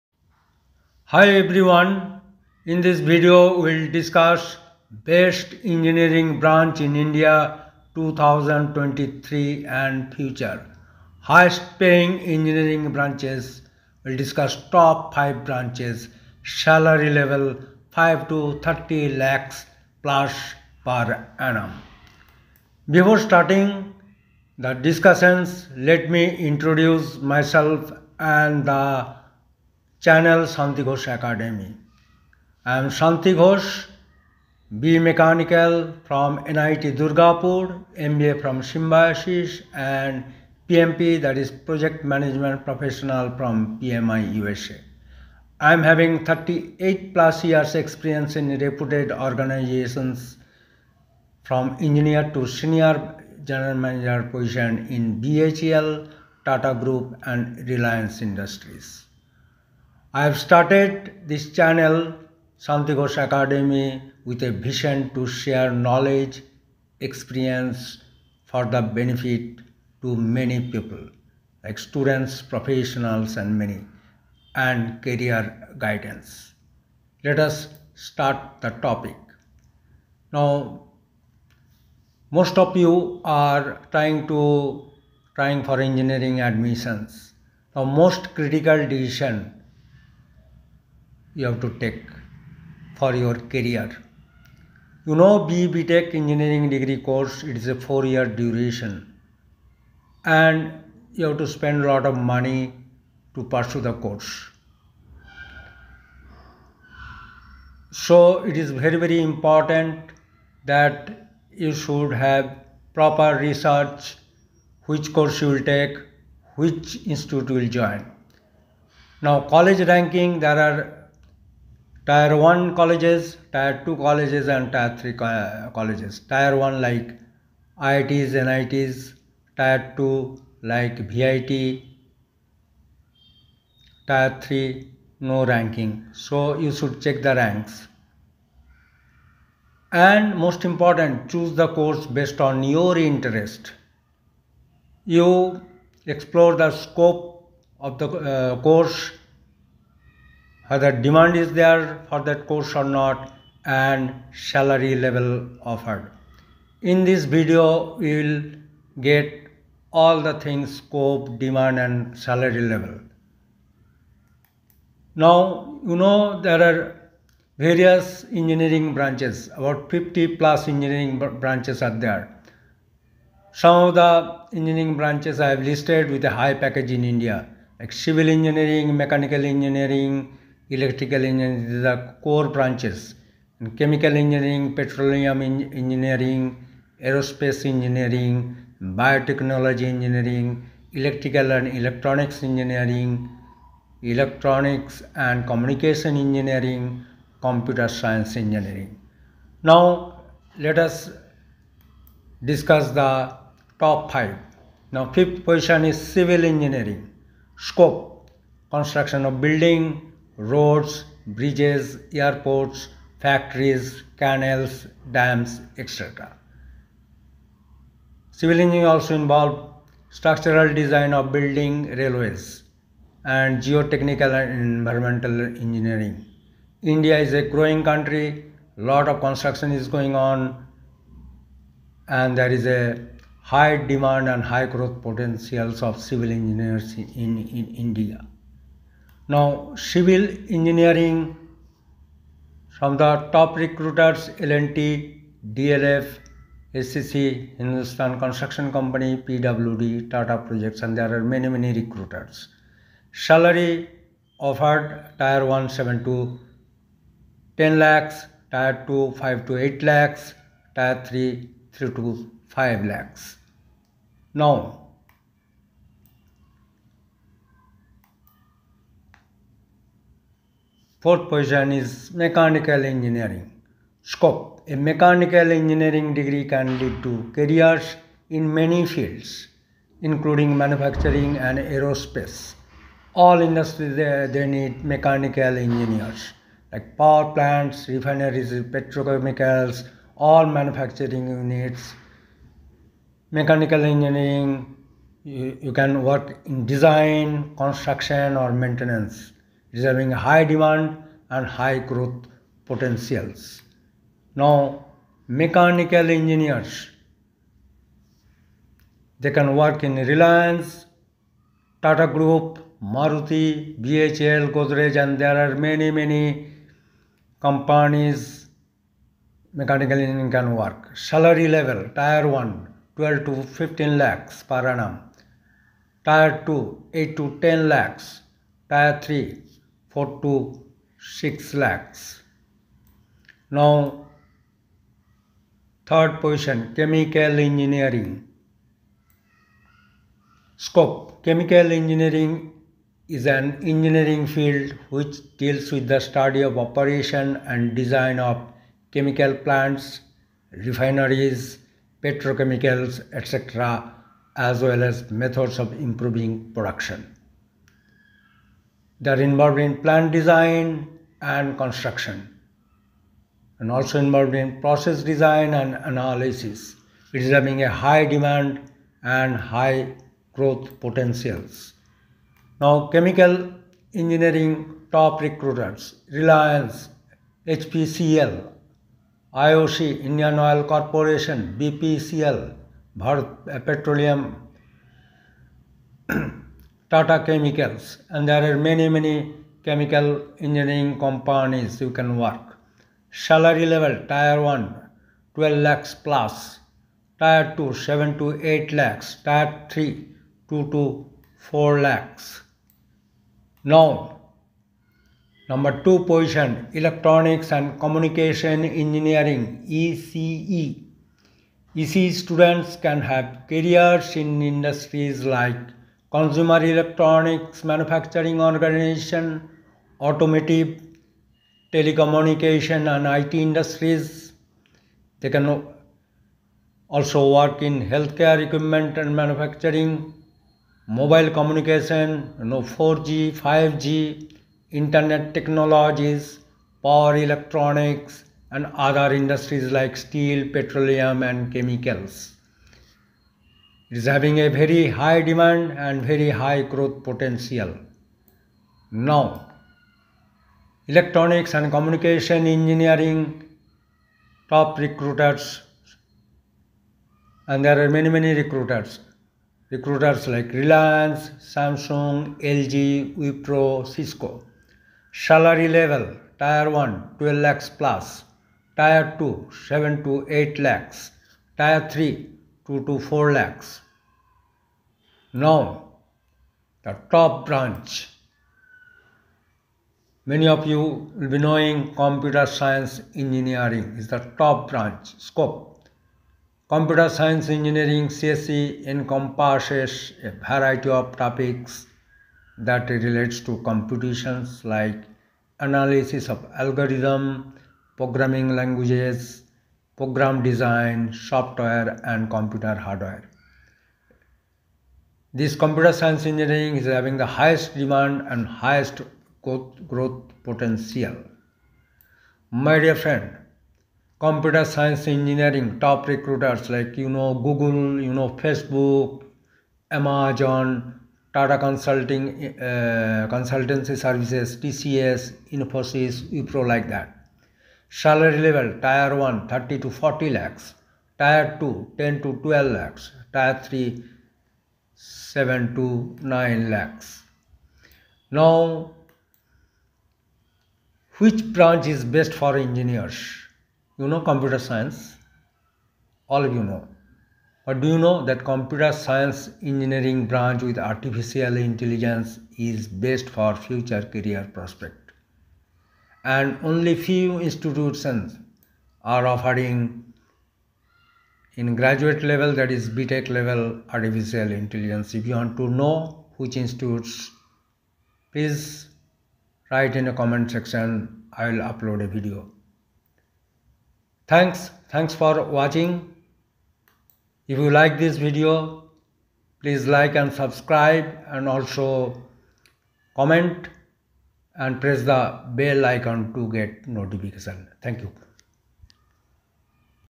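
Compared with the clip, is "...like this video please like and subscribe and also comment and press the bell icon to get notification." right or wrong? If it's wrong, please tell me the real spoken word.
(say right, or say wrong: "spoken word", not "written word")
right.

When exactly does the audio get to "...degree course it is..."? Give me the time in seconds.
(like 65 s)
96 s.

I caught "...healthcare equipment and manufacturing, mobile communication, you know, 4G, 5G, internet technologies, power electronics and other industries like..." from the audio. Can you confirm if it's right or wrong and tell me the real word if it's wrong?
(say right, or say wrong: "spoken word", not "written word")
right.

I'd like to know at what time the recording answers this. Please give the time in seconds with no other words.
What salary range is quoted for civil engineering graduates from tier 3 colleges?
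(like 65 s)
261 s.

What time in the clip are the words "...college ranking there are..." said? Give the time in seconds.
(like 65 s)
119 s.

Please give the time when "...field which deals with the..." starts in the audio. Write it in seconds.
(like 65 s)
344 s.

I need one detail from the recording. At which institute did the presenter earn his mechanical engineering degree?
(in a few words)
NIT Durgapur.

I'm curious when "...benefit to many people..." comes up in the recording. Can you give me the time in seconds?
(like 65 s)
68 s.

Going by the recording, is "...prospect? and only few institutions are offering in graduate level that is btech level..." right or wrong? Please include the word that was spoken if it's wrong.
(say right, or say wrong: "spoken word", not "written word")
right.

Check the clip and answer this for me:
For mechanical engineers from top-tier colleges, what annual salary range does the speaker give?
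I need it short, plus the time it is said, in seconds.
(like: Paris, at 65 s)
12 to 15 lakhs, at 322 s.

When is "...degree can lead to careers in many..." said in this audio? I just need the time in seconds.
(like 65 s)
276 s.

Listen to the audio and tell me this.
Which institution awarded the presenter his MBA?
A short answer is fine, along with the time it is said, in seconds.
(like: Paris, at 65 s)
Symbiosis, at 38 s.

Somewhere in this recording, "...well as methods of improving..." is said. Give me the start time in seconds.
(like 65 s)
354 s.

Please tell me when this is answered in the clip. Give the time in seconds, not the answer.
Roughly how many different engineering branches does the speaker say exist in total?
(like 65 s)
169 s.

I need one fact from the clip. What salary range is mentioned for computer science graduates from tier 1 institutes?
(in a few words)
30 to 40 lakhs.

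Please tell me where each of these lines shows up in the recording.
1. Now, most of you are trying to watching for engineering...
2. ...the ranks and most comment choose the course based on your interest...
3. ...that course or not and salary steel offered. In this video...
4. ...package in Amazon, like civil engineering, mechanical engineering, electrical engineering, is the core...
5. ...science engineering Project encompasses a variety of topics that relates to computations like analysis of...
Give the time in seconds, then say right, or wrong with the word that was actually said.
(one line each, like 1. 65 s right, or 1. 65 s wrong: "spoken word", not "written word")
1. 80 s wrong: "trying", not "watching"
2. 137 s wrong: "important", not "comment"
3. 152 s wrong: "level", not "steel"
4. 176 s wrong: "India", not "Amazon"
5. 487 s wrong: "CSE", not "Project".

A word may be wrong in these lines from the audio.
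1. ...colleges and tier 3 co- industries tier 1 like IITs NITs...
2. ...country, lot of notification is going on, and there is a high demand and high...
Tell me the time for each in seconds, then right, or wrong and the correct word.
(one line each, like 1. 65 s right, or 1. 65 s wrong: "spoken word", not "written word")
1. 123 s wrong: "colleges", not "industries"
2. 227 s wrong: "construction", not "notification".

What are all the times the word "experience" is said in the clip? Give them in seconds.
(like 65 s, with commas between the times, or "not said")
47 s, 66 s.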